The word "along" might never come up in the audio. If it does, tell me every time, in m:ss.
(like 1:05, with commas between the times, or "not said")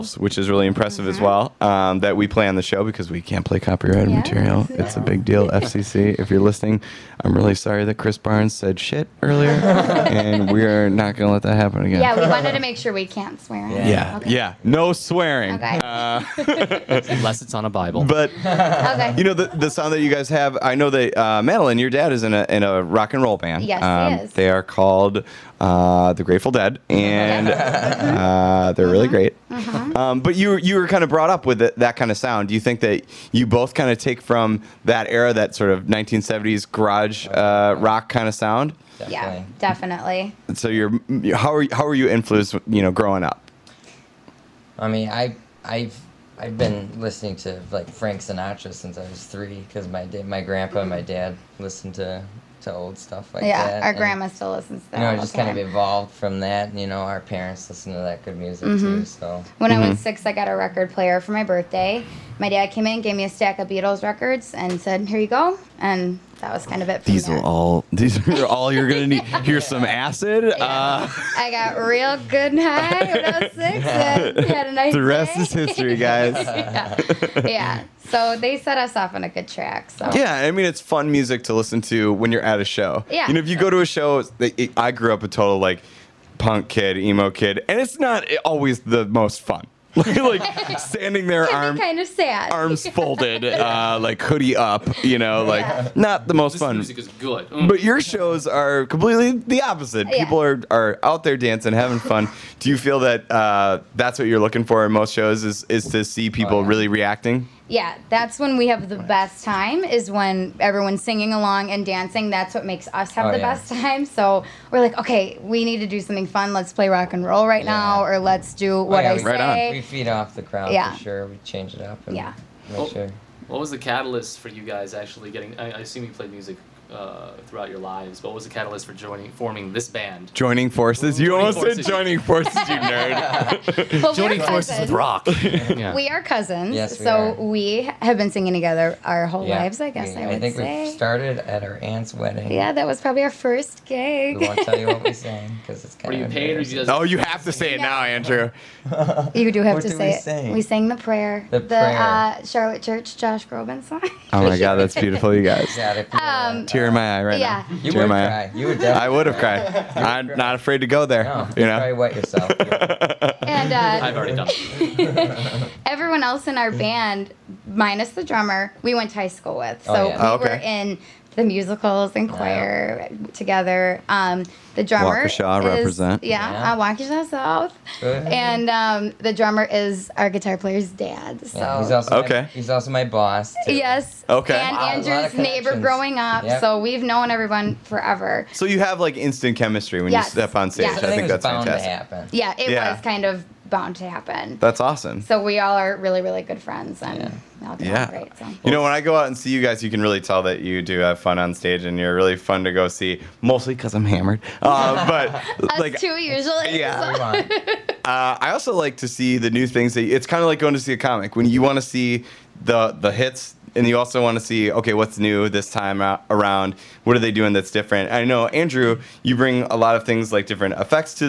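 1:51.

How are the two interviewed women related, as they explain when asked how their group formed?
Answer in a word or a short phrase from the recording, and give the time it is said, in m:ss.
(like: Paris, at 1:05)
Cousins, at 2:16.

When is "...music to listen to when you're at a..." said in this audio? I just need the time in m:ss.
1:21.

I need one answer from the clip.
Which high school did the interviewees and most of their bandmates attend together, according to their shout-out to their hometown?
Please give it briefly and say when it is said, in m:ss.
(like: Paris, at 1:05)
Waukesha South, at 2:56.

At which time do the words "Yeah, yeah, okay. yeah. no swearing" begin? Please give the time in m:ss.
0:13.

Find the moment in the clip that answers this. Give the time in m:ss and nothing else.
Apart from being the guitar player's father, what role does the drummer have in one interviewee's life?
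3:03.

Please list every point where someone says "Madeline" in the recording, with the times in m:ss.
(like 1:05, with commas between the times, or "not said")
0:21.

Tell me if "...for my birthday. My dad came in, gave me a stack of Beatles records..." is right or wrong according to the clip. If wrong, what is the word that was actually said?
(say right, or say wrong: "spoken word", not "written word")
right.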